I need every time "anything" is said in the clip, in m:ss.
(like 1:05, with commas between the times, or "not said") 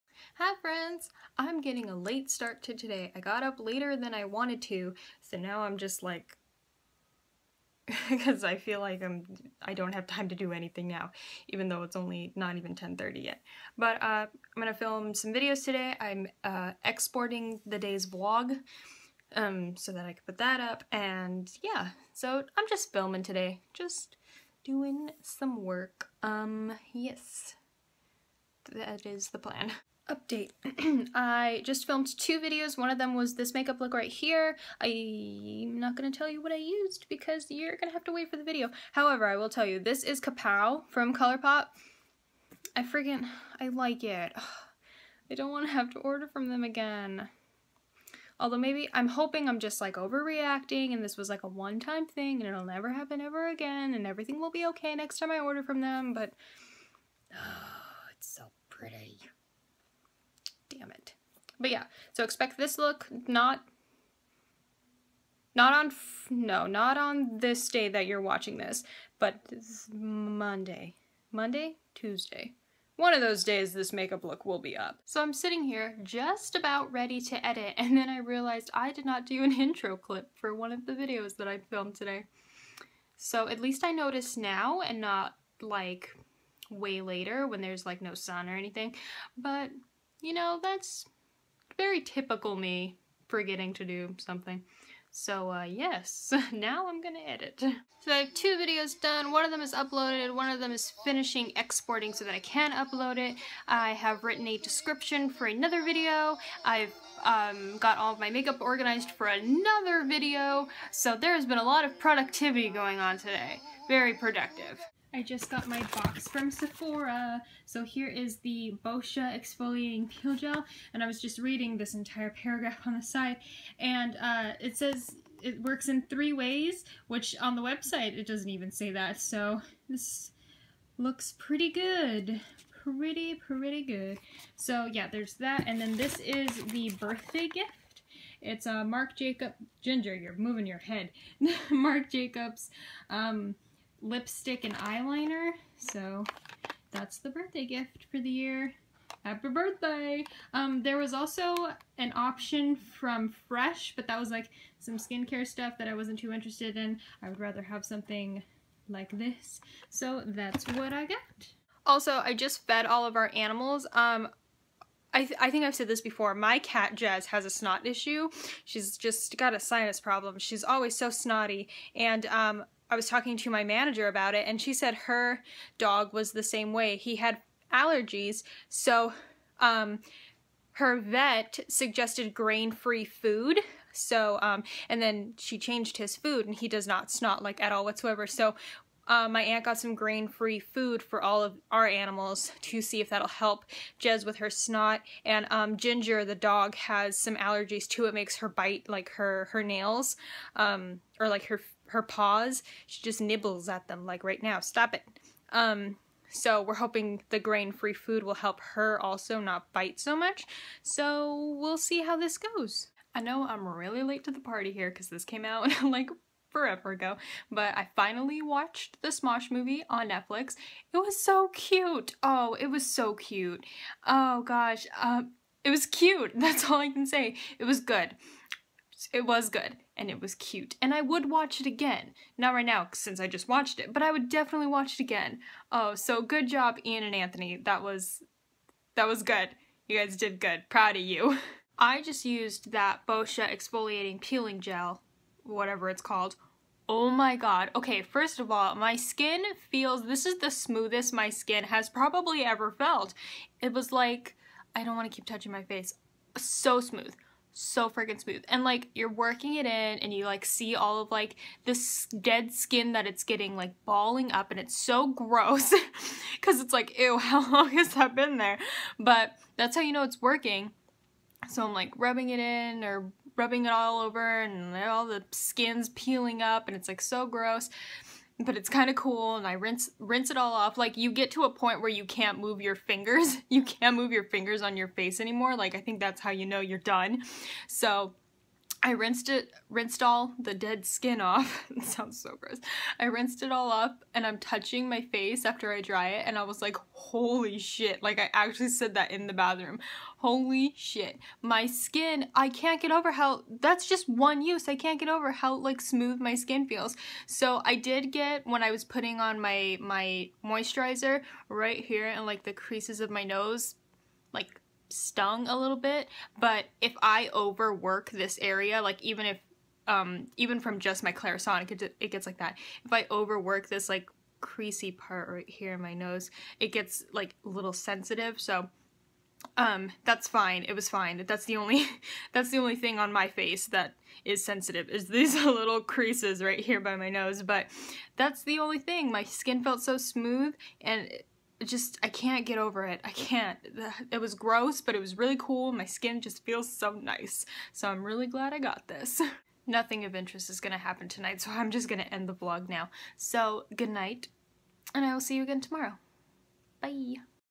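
0:10, 1:28.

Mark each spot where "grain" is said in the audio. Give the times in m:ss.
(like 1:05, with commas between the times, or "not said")
3:02, 3:09, 3:27.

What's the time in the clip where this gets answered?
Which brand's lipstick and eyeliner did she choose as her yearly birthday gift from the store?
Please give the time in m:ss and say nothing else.
2:21.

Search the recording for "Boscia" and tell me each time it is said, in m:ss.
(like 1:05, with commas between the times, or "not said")
1:58, 4:03.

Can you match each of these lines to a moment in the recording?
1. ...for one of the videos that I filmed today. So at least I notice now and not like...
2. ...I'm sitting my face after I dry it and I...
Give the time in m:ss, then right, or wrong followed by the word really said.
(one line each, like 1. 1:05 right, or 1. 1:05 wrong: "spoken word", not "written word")
1. 1:20 right
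2. 4:54 wrong: "touching", not "sitting".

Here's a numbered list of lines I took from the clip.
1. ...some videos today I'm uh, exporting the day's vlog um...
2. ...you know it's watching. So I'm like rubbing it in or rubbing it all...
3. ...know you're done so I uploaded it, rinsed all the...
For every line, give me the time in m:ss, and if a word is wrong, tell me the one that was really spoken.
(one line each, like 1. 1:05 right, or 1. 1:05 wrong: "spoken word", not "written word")
1. 0:15 right
2. 4:29 wrong: "working", not "watching"
3. 4:46 wrong: "rinsed", not "uploaded".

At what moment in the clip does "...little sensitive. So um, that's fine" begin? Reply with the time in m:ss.
5:27.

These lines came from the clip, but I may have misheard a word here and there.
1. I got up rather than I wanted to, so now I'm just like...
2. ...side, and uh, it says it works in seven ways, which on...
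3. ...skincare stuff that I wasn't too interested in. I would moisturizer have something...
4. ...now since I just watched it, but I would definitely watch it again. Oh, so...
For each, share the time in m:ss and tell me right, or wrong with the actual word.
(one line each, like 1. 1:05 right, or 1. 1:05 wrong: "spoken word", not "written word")
1. 0:03 wrong: "later", not "rather"
2. 2:03 wrong: "three", not "seven"
3. 2:34 wrong: "rather", not "moisturizer"
4. 3:52 right.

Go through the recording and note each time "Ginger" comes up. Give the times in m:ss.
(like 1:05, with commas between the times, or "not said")
2:19, 3:15.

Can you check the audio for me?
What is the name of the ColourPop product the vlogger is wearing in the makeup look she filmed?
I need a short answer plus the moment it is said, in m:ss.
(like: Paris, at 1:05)
Kapow, at 0:40.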